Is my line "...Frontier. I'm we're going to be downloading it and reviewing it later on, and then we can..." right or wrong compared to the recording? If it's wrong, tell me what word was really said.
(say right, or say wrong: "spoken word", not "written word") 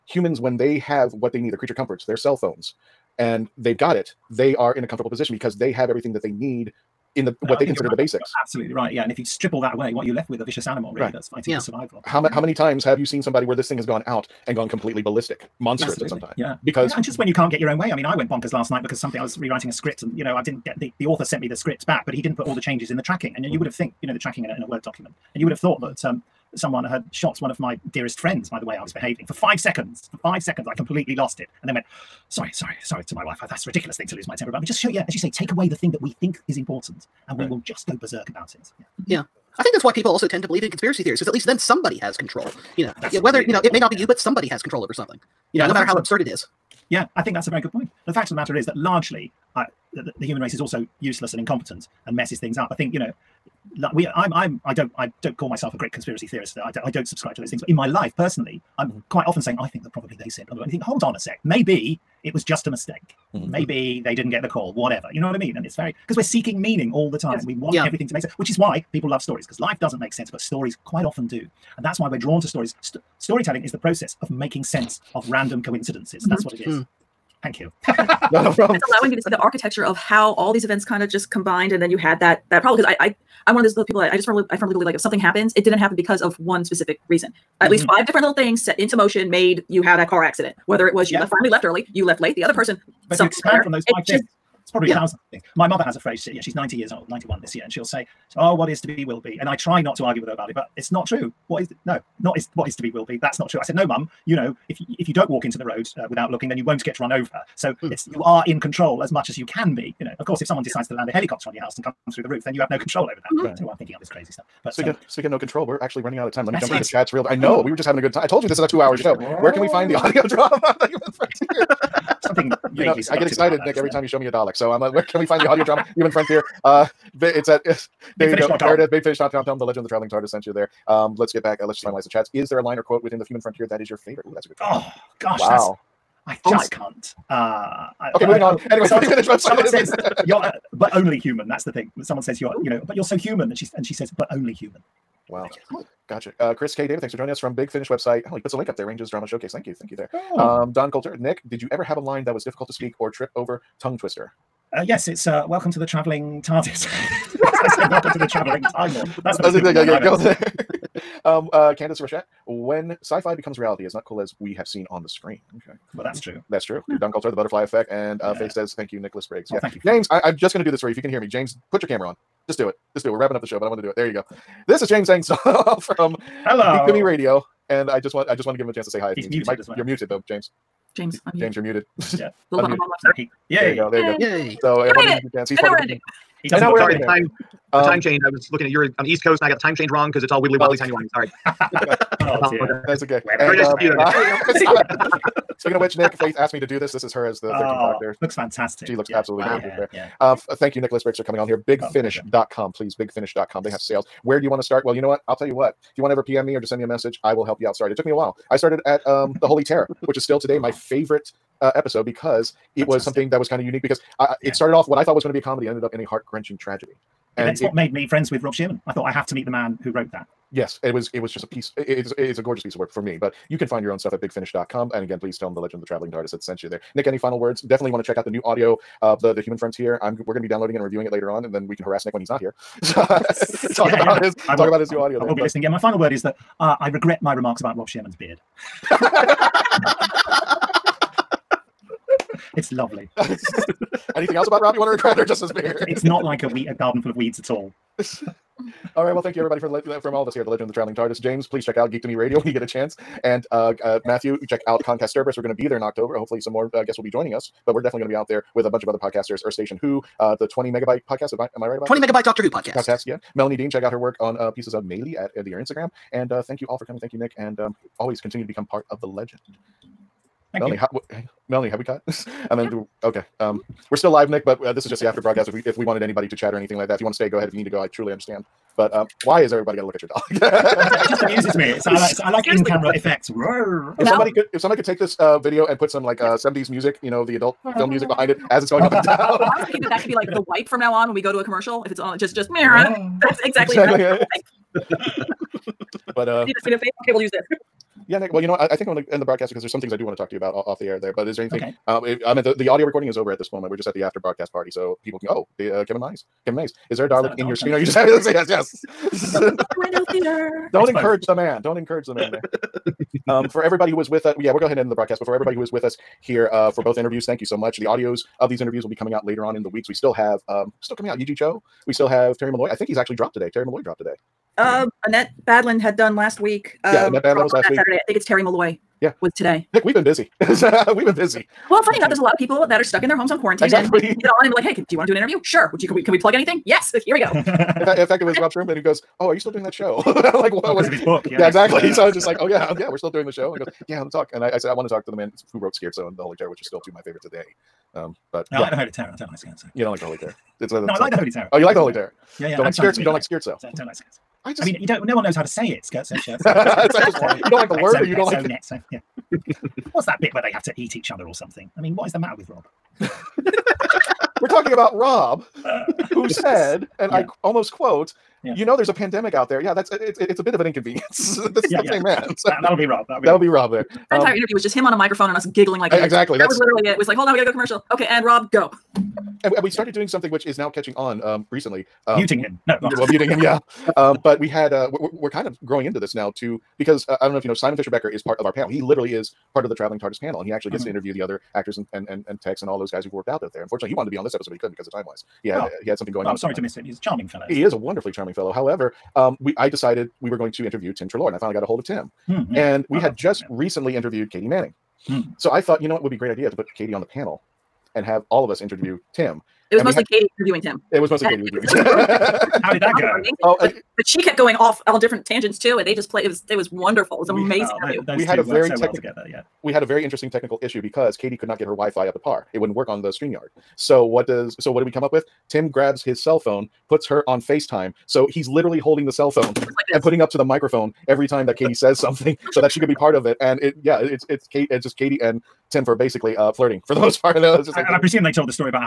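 right.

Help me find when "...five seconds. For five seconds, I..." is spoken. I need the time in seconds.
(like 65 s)
29 s.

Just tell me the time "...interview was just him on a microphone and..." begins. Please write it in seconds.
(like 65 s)
374 s.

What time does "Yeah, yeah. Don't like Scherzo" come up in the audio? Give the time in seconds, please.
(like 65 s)
352 s.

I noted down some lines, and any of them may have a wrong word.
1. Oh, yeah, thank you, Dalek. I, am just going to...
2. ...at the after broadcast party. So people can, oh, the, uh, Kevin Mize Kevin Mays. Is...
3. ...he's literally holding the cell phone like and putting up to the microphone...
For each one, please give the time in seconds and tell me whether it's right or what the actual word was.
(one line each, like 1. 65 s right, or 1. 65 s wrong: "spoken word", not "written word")
1. 169 s wrong: "James", not "Dalek"
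2. 303 s right
3. 428 s right.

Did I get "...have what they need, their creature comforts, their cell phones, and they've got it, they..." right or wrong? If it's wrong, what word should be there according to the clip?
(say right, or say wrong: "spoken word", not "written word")
right.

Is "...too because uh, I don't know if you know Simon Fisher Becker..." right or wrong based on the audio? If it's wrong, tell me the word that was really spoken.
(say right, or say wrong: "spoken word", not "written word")
right.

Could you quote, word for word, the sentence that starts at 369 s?
Yeah, that's it's it's a bit of an inconvenience.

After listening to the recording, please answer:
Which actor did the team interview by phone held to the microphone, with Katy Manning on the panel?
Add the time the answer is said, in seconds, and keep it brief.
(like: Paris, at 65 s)
Tim Treloar, at 400 s.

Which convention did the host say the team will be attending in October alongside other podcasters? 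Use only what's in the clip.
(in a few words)
Con Kasterborous.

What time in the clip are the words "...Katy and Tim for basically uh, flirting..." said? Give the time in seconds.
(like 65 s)
434 s.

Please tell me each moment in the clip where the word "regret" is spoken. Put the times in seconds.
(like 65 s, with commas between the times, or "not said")
236 s, 244 s.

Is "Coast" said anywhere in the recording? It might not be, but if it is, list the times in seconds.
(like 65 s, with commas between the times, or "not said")
189 s.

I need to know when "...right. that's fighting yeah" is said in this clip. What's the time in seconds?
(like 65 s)
11 s.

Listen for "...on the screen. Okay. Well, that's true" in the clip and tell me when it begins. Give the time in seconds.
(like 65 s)
164 s.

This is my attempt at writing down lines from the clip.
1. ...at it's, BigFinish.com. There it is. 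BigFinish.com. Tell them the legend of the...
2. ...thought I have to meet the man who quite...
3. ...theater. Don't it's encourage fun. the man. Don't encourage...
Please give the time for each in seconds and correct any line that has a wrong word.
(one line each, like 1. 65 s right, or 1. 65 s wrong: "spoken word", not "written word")
1. 127 s right
2. 218 s wrong: "wrote", not "quite"
3. 310 s right.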